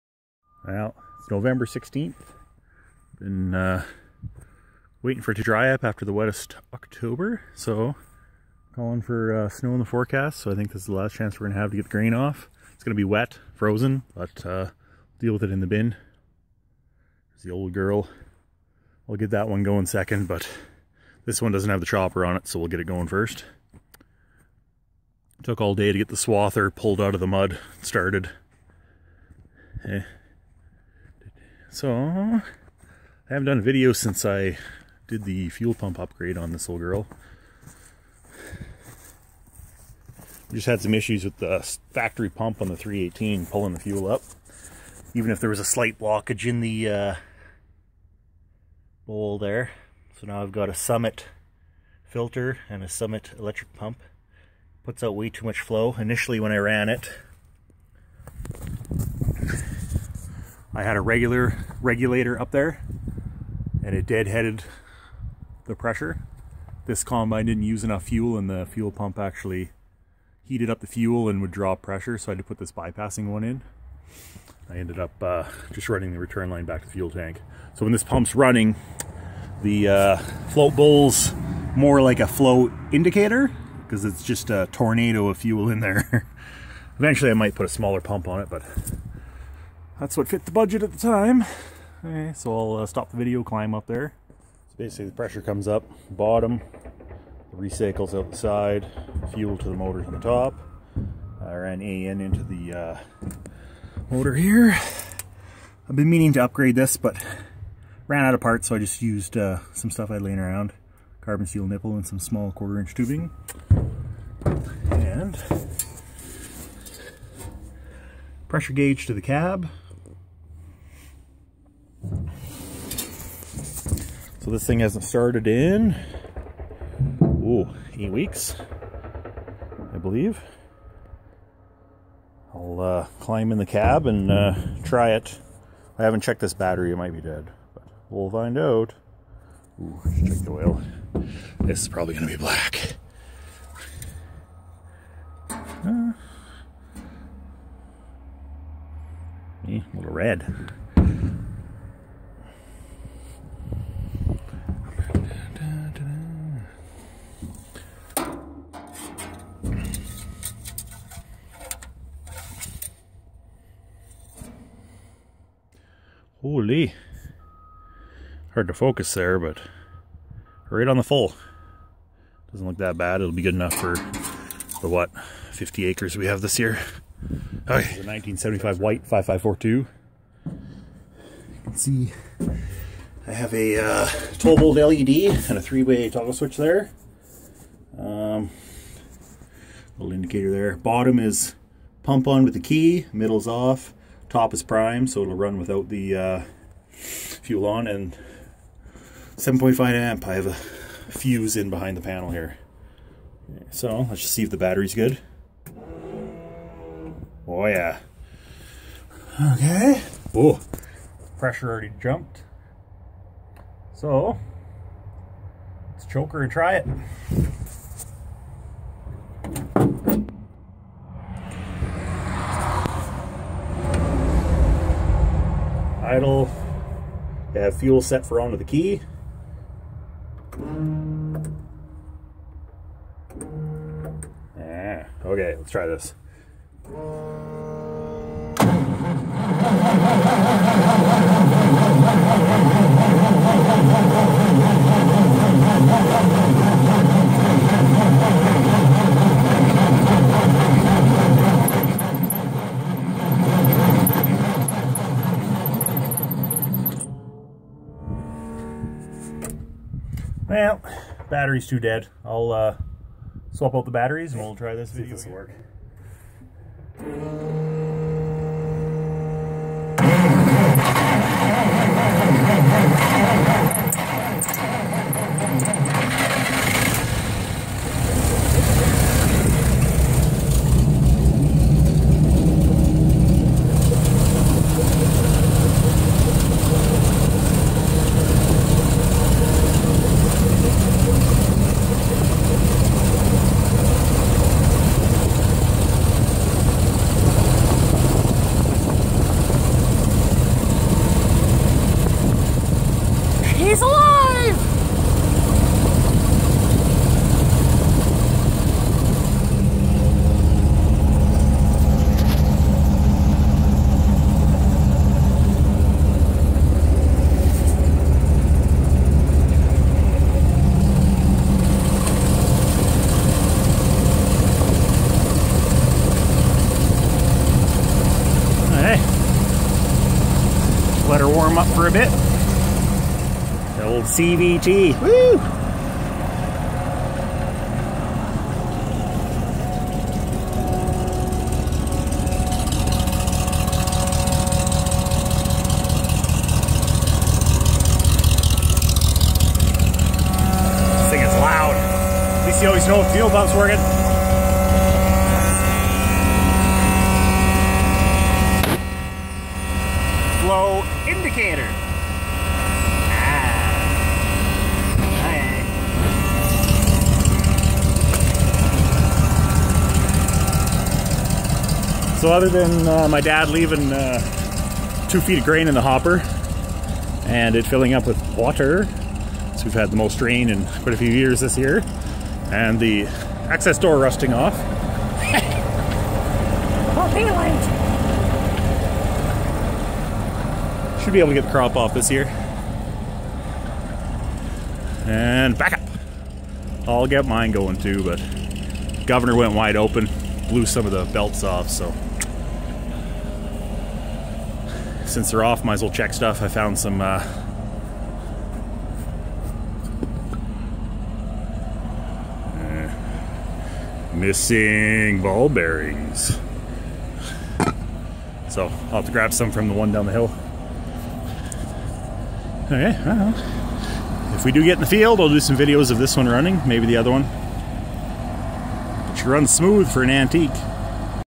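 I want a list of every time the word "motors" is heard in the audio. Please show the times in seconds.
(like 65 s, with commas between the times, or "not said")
99 s, 104 s.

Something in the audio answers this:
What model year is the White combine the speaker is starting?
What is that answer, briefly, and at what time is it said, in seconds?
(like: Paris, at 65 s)
1975, at 178 s.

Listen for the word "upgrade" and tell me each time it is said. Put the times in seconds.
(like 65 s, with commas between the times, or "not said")
35 s, 106 s.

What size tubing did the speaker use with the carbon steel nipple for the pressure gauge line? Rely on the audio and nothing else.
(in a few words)
quarter inch.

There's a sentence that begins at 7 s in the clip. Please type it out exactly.
So calling for uh, snow in the forecast.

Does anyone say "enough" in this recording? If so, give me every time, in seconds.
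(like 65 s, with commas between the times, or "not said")
67 s, 173 s.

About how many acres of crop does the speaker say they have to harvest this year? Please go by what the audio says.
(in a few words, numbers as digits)
50.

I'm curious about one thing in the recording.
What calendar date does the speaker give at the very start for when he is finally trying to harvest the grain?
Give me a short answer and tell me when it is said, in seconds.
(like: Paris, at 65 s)
November 16th, at 1 s.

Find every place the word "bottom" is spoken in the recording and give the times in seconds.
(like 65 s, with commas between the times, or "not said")
96 s, 190 s.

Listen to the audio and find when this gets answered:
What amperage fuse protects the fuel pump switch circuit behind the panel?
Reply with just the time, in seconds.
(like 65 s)
199 s.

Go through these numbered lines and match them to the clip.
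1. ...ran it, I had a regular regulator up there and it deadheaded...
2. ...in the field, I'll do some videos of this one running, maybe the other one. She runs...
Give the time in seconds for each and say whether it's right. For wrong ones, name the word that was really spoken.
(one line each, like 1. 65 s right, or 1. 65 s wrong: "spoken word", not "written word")
1. 56 s right
2. 424 s right.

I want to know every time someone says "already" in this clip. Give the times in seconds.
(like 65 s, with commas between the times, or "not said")
211 s.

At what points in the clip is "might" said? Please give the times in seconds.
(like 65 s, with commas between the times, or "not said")
87 s, 136 s, 405 s.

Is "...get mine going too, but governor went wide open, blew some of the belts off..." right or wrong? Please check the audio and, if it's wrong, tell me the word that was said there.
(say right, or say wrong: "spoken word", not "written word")
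right.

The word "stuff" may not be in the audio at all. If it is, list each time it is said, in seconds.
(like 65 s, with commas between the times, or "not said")
109 s, 406 s.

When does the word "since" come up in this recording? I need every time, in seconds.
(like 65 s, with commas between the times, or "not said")
33 s, 405 s.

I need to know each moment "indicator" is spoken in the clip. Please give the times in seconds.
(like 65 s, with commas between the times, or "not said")
82 s, 190 s, 361 s.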